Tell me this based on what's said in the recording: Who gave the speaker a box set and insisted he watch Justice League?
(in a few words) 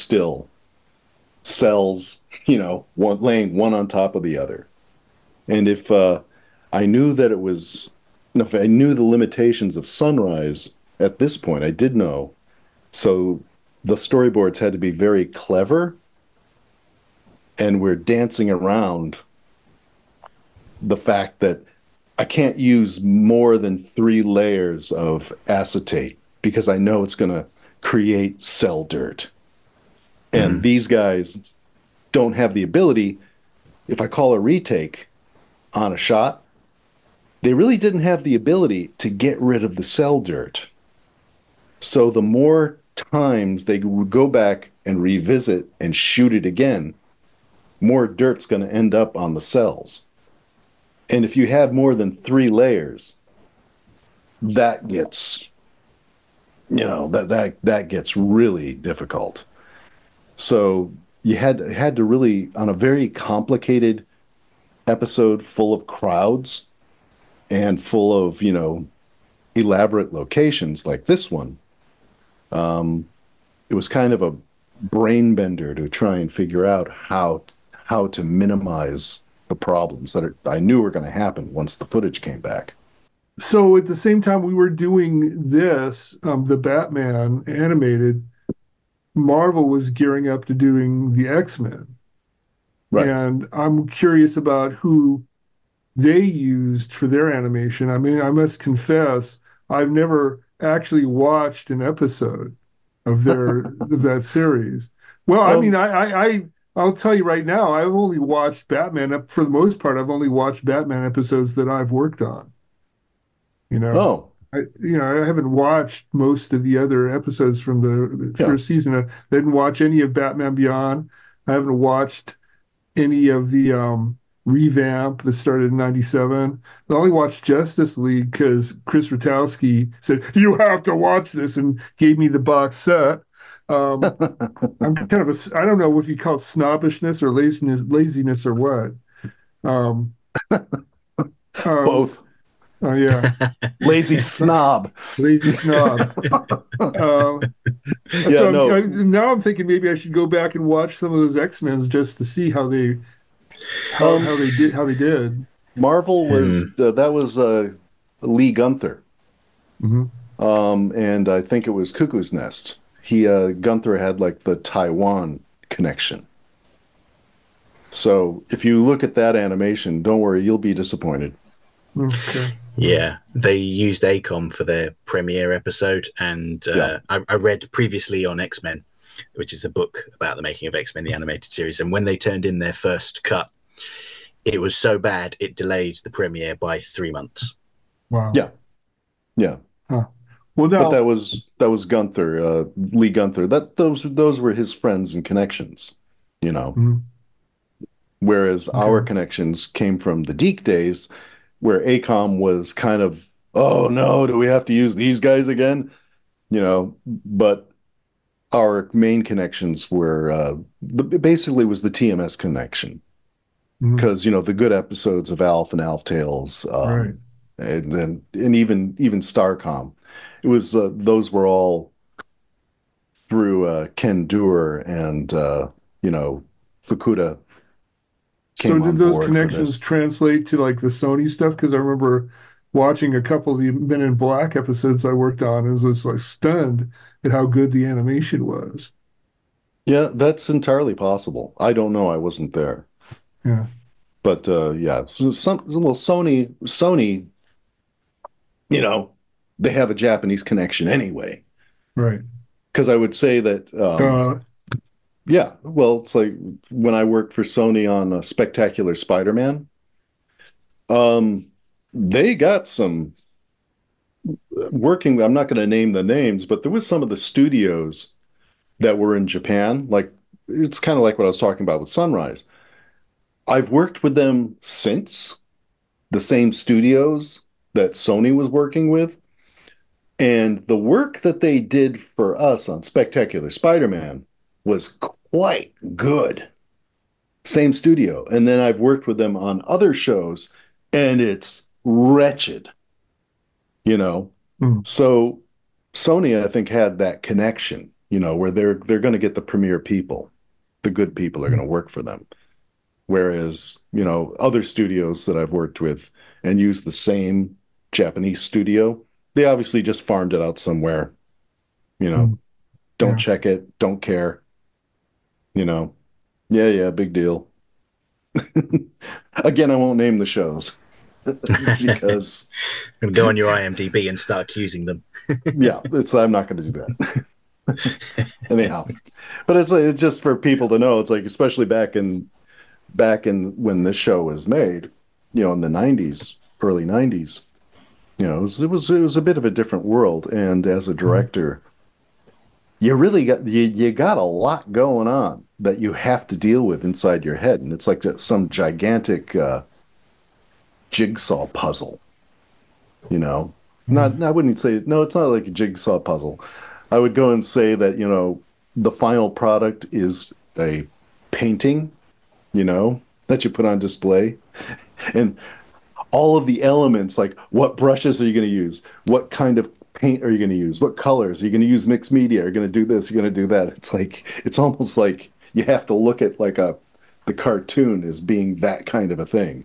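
Chris Rutowski.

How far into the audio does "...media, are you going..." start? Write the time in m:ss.
6:12.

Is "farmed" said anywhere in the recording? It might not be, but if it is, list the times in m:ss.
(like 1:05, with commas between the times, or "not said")
5:10.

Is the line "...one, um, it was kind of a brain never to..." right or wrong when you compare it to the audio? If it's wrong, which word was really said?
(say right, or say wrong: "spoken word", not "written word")
wrong: "bender", not "never".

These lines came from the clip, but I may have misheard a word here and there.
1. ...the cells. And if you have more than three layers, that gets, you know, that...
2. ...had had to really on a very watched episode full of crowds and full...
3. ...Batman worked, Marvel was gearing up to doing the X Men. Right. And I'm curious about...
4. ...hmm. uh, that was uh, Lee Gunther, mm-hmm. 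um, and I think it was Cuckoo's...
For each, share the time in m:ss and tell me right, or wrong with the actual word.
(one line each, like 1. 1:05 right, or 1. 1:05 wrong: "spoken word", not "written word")
1. 0:49 right
2. 1:01 wrong: "complicated", not "watched"
3. 1:26 wrong: "animated", not "worked"
4. 2:36 right.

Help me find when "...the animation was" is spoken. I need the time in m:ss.
3:57.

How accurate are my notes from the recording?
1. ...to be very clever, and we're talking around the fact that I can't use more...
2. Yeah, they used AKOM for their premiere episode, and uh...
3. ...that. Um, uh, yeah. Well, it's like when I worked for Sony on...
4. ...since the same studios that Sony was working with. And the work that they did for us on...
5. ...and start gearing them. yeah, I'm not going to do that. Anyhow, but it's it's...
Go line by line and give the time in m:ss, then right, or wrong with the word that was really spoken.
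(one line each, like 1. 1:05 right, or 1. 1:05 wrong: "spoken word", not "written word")
1. 0:14 wrong: "dancing", not "talking"
2. 2:52 right
3. 4:13 right
4. 4:34 right
5. 5:24 wrong: "accusing", not "gearing".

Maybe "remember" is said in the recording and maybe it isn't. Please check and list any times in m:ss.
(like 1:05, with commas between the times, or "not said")
3:51.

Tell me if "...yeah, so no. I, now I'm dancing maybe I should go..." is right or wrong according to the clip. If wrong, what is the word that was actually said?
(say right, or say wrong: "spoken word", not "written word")
wrong: "thinking", not "dancing".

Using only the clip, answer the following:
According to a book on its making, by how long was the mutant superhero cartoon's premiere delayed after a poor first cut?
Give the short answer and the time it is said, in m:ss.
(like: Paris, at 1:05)
3 months, at 3:06.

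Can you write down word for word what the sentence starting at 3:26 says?
You know, but our main connections were uh, basically was the TMS connection because mm-hmm.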